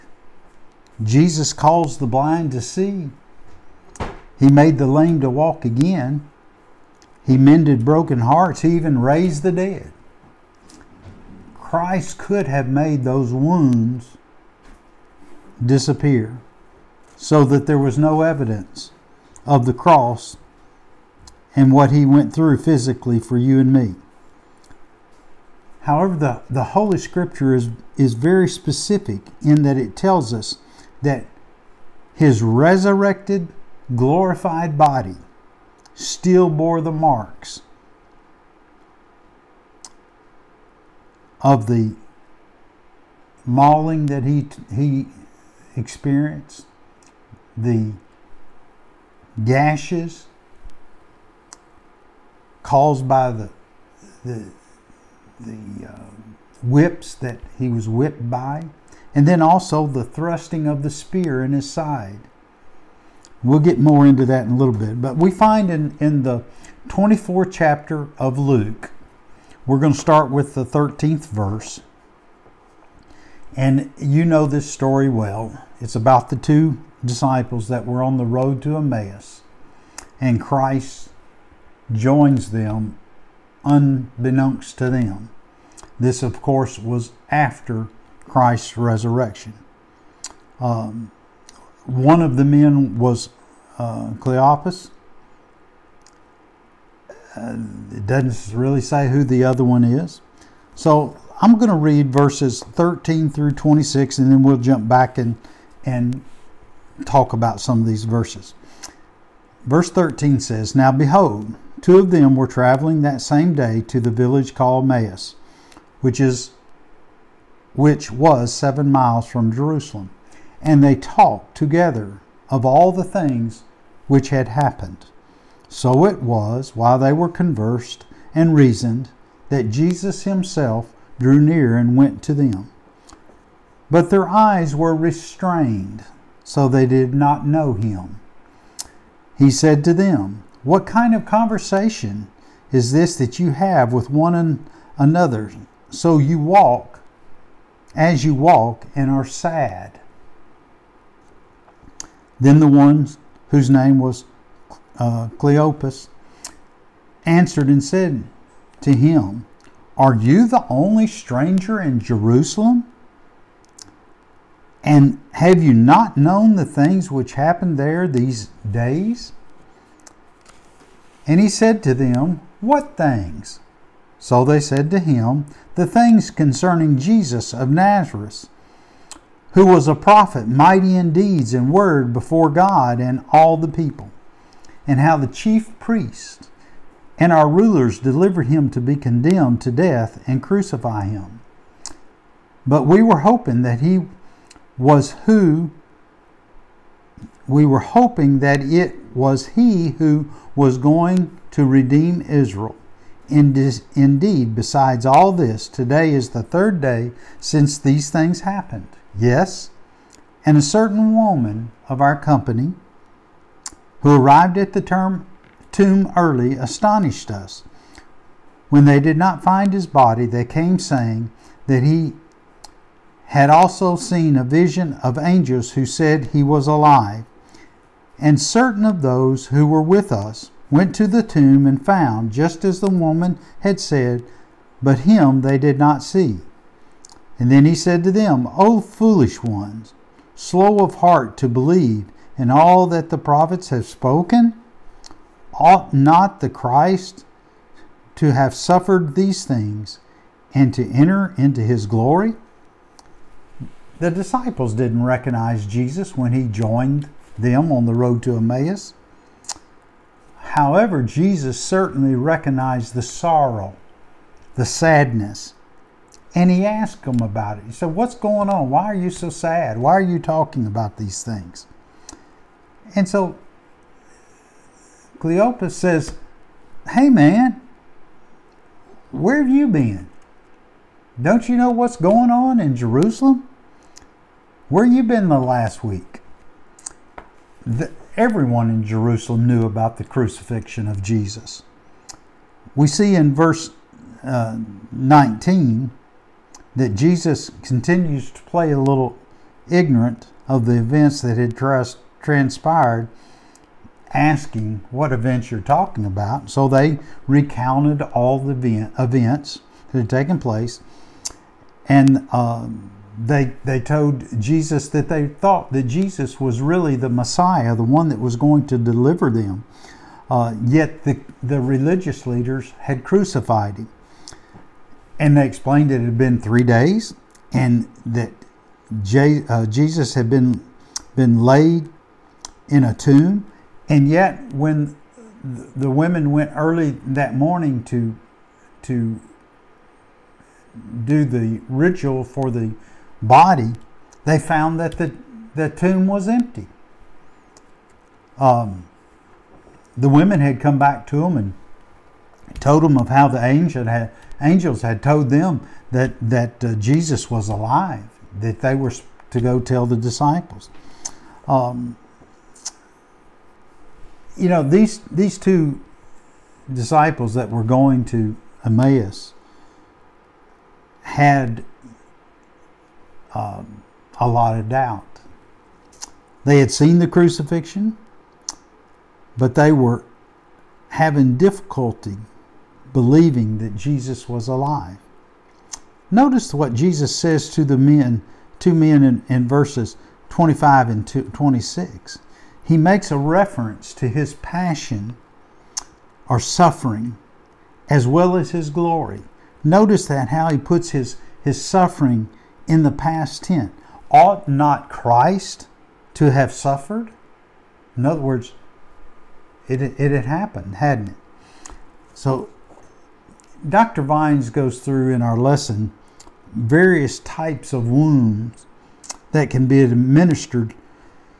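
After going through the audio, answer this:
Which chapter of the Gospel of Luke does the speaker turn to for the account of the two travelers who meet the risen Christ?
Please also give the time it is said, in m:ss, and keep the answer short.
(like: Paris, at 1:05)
24th, at 1:06.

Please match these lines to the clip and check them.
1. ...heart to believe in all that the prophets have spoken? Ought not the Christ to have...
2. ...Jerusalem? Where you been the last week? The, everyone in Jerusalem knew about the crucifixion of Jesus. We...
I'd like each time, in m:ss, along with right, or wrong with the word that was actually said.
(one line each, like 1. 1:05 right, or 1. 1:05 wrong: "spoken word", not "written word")
1. 4:00 right
2. 4:42 right.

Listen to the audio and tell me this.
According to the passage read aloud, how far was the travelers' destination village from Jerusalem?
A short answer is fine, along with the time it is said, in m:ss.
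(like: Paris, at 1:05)
7 miles, at 1:58.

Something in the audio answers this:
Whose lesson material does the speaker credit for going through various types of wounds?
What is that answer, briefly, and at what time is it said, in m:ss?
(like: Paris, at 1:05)
Dr. Vines, at 6:53.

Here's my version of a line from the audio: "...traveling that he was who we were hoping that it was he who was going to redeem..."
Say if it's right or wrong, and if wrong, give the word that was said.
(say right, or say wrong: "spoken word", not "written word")
wrong: "hoping", not "traveling".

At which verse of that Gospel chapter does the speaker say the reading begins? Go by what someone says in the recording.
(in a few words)
13th.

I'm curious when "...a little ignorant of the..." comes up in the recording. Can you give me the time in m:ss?
4:58.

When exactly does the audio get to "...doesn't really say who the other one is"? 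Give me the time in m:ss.
1:38.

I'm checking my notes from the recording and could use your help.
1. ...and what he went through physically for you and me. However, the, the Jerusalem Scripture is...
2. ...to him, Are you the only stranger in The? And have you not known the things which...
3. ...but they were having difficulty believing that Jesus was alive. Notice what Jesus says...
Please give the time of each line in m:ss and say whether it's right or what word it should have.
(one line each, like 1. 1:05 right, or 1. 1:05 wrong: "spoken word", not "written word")
1. 0:21 wrong: "Holy", not "Jerusalem"
2. 2:38 wrong: "Jerusalem", not "The"
3. 6:19 right.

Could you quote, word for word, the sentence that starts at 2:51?
And he said to them, What things?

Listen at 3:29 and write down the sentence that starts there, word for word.
Yes, and a certain woman of our company who arrived at the term, tomb early astonished us.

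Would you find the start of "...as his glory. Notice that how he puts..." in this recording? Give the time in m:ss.
6:38.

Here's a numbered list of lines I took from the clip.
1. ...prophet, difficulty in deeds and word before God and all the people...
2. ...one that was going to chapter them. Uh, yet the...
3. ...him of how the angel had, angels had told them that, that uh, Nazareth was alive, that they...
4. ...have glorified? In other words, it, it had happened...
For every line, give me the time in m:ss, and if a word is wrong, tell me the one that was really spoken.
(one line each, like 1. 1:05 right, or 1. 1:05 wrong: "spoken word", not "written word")
1. 2:59 wrong: "mighty", not "difficulty"
2. 5:17 wrong: "deliver", not "chapter"
3. 5:52 wrong: "Jesus", not "Nazareth"
4. 6:46 wrong: "suffered", not "glorified".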